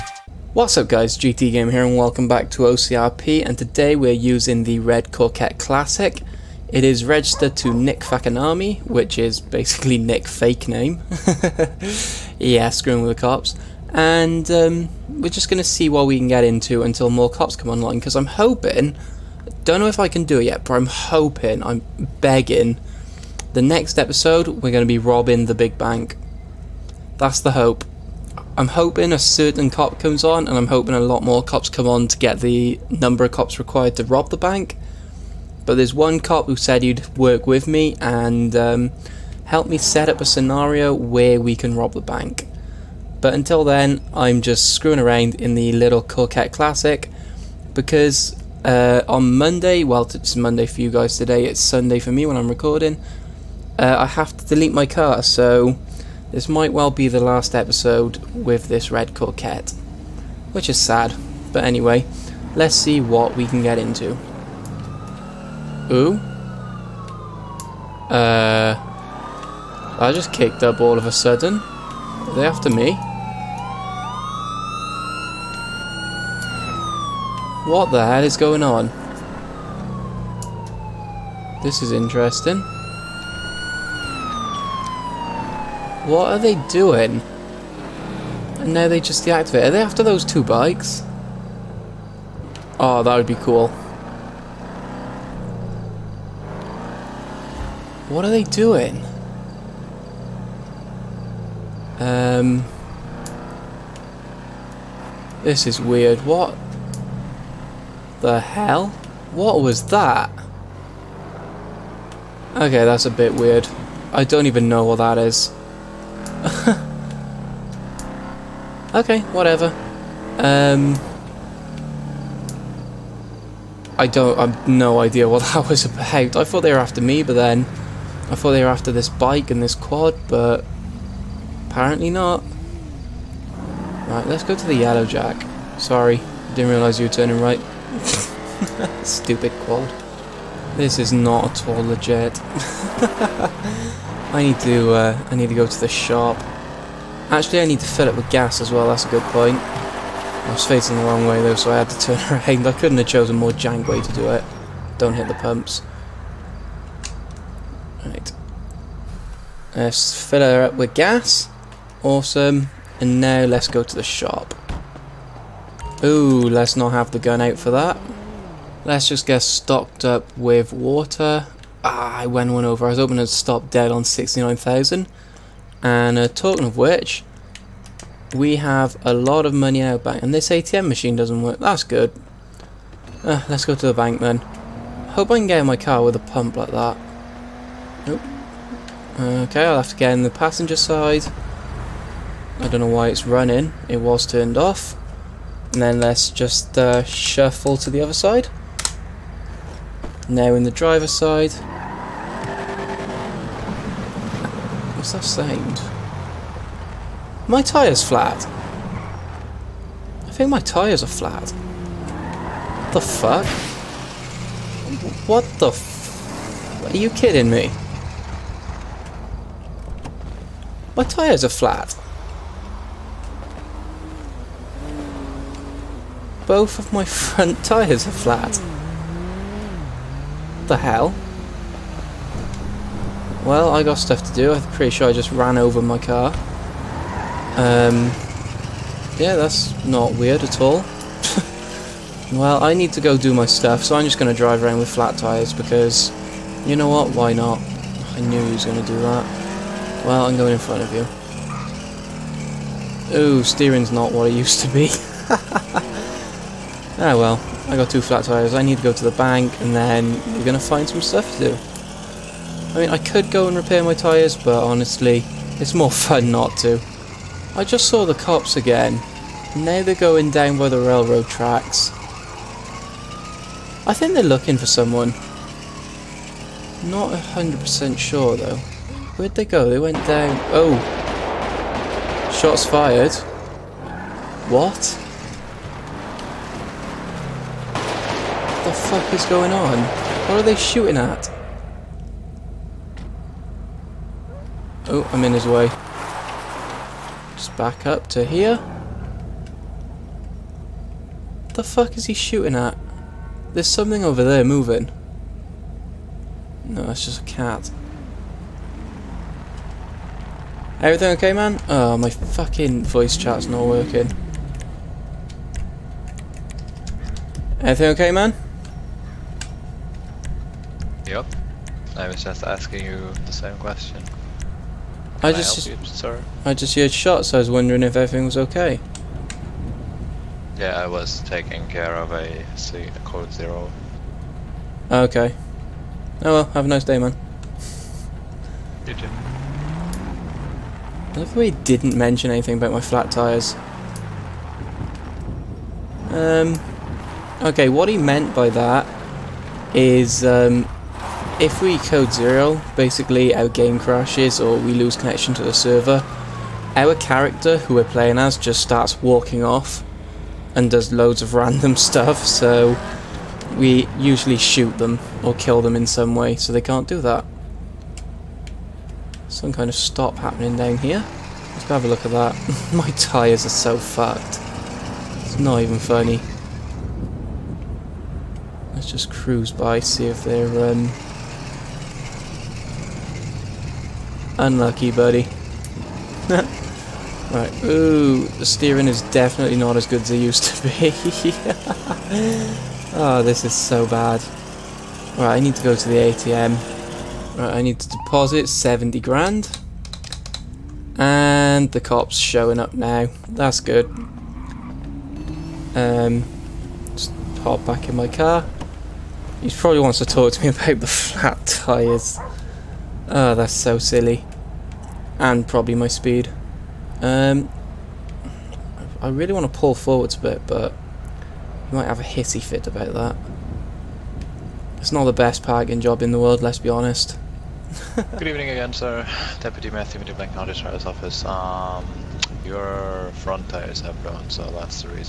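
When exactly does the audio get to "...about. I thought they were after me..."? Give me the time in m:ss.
2:05.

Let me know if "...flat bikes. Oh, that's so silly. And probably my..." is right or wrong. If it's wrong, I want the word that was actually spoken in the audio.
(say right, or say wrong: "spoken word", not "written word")
wrong: "tyres", not "bikes".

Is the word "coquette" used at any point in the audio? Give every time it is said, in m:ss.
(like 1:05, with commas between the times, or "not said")
0:05, 0:46, 0:59.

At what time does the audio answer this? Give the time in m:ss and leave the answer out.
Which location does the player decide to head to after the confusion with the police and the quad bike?
2:14.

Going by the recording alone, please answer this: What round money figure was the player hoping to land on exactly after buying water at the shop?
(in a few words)
69,000.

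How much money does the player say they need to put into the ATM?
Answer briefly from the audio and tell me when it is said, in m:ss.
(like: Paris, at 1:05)
70 grand, at 6:38.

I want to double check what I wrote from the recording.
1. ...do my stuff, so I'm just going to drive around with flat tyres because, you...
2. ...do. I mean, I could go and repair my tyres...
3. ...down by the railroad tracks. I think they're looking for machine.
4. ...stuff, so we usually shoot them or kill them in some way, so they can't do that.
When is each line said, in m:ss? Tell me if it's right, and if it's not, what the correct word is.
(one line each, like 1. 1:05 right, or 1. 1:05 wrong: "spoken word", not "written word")
1. 4:03 right
2. 4:21 right
3. 4:30 wrong: "someone", not "machine"
4. 6:01 right.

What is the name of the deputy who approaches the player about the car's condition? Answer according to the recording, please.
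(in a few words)
Deputy Matthew.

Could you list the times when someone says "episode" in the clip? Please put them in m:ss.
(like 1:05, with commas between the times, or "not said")
0:23, 0:57.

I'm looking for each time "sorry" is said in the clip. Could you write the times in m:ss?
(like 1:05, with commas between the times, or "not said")
2:15, 5:25.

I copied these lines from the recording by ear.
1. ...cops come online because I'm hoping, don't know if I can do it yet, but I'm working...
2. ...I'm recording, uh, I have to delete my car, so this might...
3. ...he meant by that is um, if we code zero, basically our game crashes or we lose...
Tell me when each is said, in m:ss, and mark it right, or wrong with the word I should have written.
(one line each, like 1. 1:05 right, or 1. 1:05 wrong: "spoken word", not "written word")
1. 0:17 wrong: "hoping", not "working"
2. 0:52 right
3. 5:47 right.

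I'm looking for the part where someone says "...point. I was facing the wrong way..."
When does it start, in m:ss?
2:29.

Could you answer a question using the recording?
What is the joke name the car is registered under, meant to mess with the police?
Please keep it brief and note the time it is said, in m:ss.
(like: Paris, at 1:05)
Nick Fakanami, at 0:07.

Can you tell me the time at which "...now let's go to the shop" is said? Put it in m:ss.
2:43.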